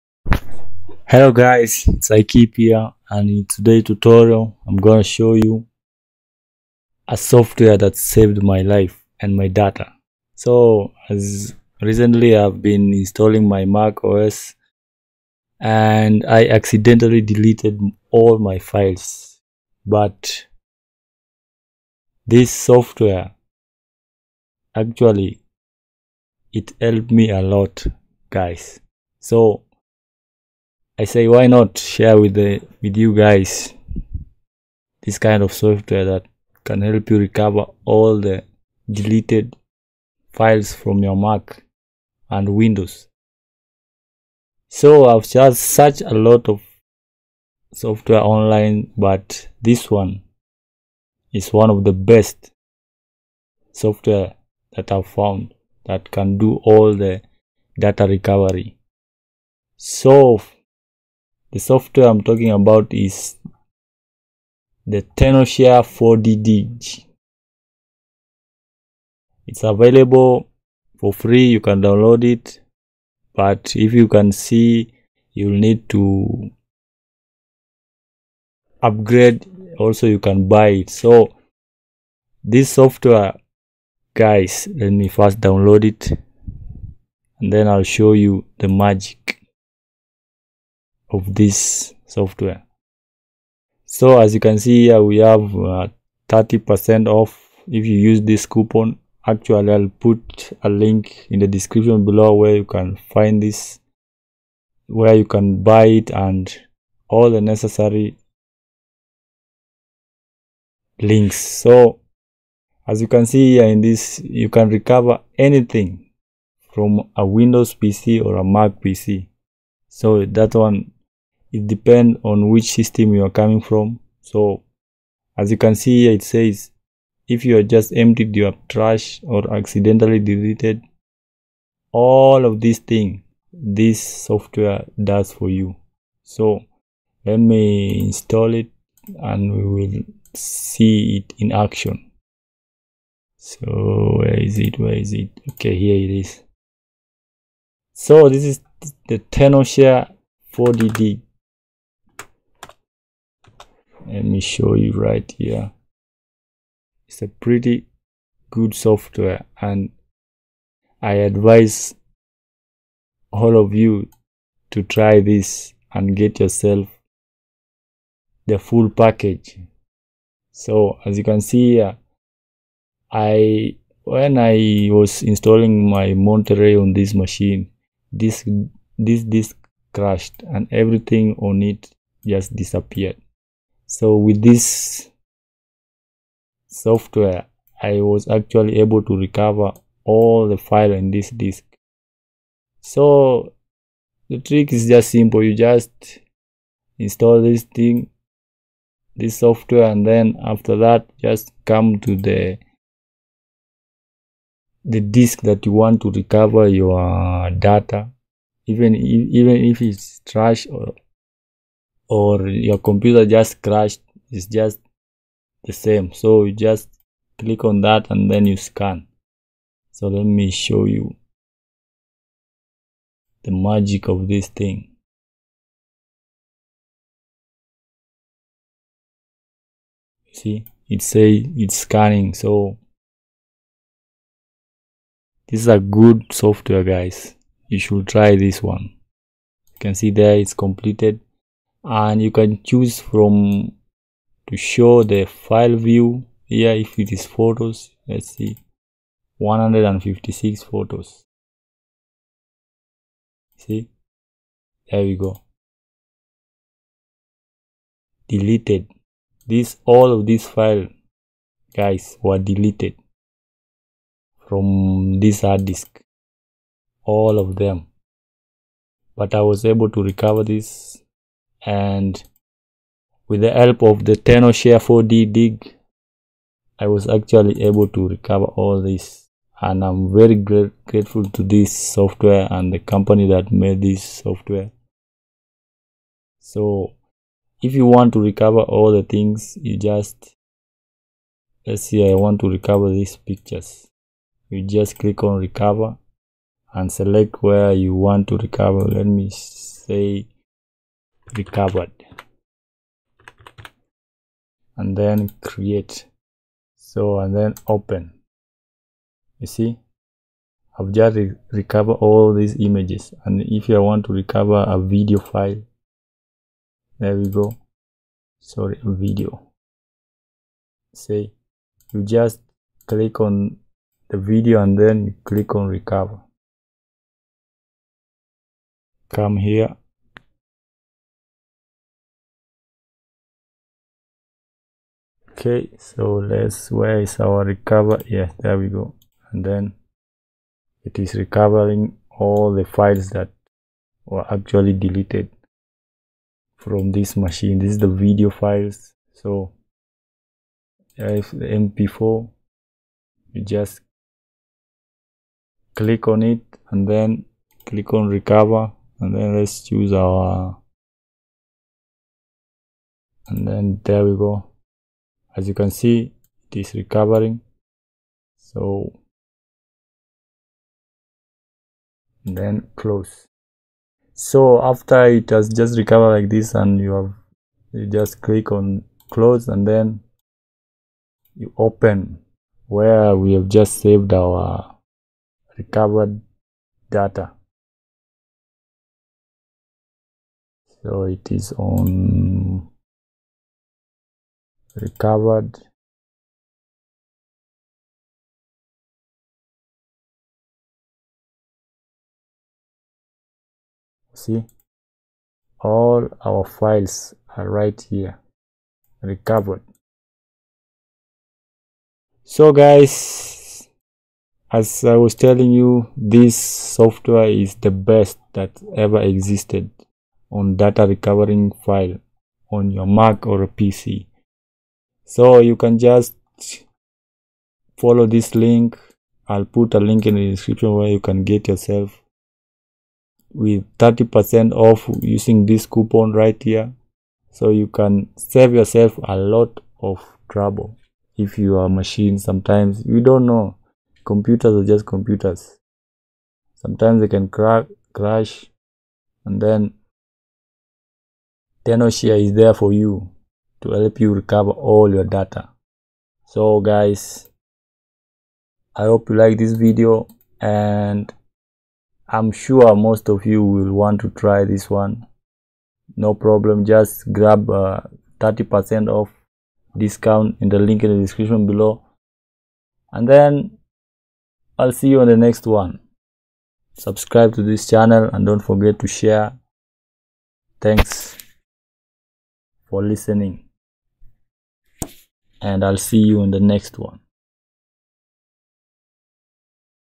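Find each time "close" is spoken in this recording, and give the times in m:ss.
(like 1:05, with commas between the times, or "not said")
6:12, 6:19.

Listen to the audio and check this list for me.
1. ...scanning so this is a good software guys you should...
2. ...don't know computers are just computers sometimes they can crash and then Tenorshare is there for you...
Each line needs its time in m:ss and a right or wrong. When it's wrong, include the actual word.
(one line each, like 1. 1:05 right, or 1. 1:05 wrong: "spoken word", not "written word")
1. 3:51 right
2. 7:23 right.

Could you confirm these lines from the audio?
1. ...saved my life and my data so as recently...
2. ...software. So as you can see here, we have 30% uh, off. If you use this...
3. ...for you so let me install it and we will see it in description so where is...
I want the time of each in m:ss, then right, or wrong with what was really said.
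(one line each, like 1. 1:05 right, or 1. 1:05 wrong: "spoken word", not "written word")
1. 0:07 right
2. 1:32 right
3. 2:15 wrong: "action", not "description".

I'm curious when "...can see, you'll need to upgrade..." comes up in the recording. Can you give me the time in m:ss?
1:14.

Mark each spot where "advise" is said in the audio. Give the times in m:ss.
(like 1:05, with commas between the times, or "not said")
2:41.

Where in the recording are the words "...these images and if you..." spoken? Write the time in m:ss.
5:12.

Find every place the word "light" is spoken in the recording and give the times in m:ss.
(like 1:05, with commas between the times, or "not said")
not said.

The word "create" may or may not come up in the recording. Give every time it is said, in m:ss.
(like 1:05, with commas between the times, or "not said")
5:05.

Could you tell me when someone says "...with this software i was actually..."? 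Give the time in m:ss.
3:04.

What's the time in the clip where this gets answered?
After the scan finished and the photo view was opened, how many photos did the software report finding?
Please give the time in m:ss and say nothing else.
4:09.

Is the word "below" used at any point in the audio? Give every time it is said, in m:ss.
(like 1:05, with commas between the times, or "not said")
1:42, 7:51.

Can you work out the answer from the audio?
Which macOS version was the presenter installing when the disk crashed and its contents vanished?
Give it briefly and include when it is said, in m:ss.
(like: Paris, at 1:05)
Monterey, at 2:56.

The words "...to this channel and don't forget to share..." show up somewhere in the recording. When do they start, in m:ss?
7:57.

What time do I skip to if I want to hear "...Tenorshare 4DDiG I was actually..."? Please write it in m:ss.
4:34.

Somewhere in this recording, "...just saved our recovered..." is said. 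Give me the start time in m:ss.
6:23.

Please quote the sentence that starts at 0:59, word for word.
So the software i'm talking about is the Tenorshare 4DDiG.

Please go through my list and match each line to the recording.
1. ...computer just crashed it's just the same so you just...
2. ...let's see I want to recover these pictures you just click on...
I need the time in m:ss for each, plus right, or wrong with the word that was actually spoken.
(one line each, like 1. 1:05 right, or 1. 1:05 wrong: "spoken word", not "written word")
1. 3:32 right
2. 4:51 right.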